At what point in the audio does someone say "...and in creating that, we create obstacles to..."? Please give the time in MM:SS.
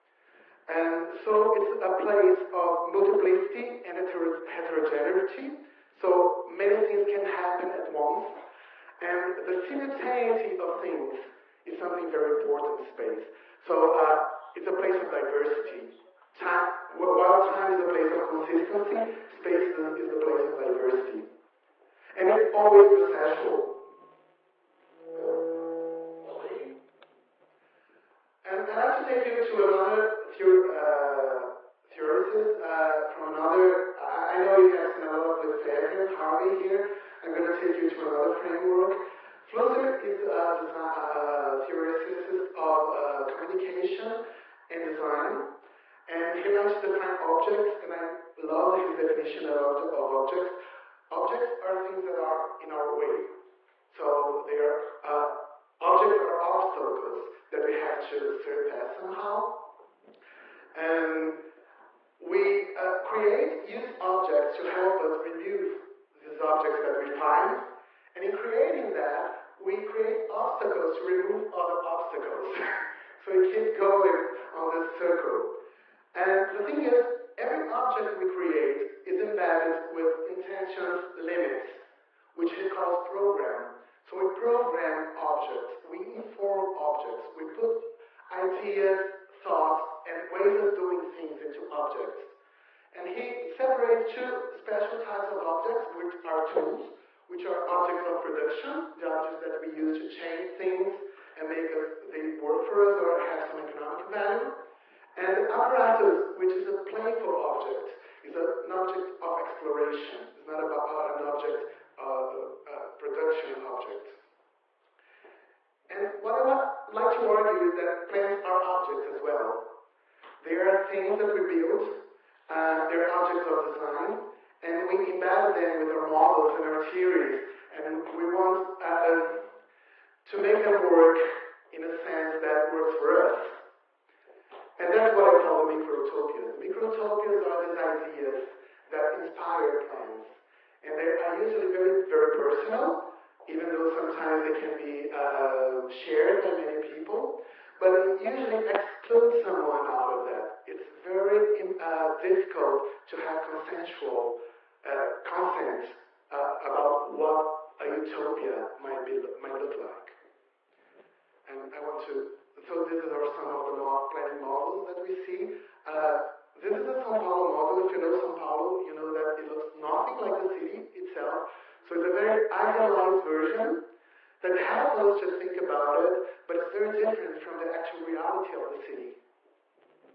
01:08.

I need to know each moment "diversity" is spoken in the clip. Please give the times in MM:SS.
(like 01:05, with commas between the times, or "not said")
00:15, 00:20.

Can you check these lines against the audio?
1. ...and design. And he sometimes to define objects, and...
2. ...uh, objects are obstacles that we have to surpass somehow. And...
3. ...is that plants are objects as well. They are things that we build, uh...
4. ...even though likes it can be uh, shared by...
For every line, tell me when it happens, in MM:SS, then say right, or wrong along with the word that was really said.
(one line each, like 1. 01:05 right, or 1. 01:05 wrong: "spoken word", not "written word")
1. 00:44 wrong: "likes", not "sometimes"
2. 00:55 right
3. 01:57 right
4. 02:23 wrong: "sometimes", not "likes".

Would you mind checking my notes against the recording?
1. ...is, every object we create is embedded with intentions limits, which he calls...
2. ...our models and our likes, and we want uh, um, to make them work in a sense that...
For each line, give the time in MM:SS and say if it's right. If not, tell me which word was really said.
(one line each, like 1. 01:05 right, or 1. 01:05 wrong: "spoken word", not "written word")
1. 01:16 right
2. 02:05 wrong: "theories", not "likes".